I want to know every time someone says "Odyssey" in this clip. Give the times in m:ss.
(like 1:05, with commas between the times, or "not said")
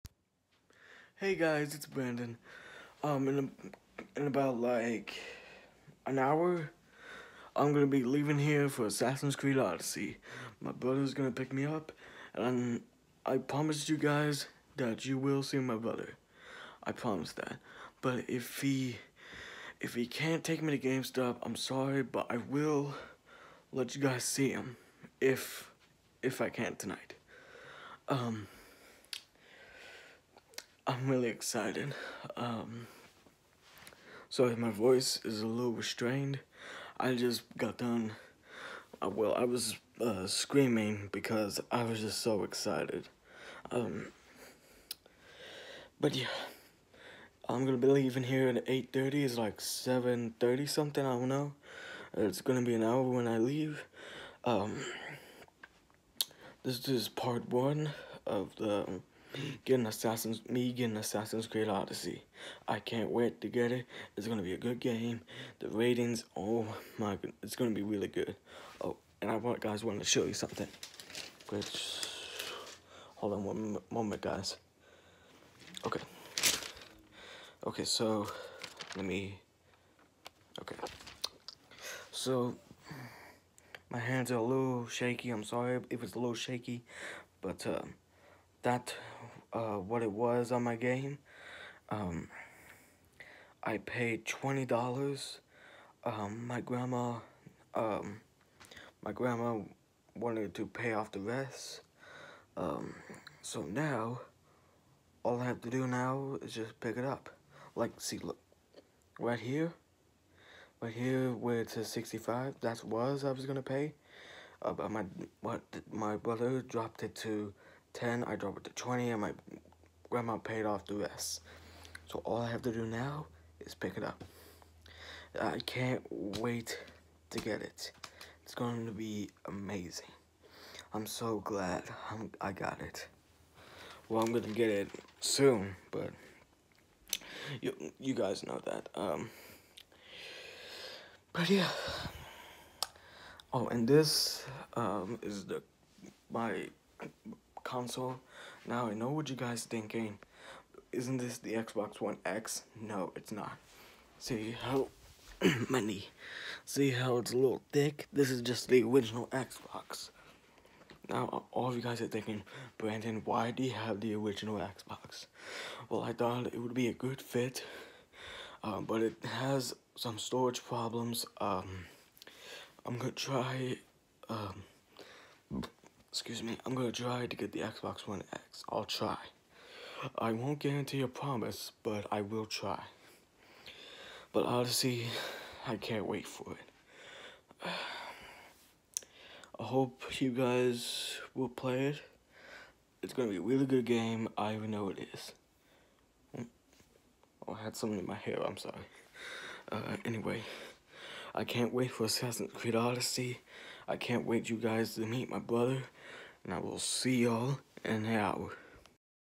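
0:09, 1:01, 3:22.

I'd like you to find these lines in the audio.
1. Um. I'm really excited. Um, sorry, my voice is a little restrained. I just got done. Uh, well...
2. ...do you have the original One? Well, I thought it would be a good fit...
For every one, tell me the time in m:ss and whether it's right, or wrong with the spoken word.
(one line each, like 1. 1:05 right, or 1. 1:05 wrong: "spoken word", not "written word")
1. 0:28 right
2. 2:43 wrong: "Xbox", not "One".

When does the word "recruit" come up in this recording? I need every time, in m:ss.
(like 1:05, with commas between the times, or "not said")
not said.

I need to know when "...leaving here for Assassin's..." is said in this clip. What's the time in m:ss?
0:08.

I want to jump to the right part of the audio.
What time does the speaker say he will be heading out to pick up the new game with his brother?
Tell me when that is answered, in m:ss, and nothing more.
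0:48.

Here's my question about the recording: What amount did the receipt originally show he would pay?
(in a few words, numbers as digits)
65.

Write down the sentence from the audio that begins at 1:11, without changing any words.
Which, hold on one moment, guys.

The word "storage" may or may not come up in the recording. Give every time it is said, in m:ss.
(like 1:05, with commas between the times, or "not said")
2:50.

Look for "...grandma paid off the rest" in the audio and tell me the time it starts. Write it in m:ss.
2:00.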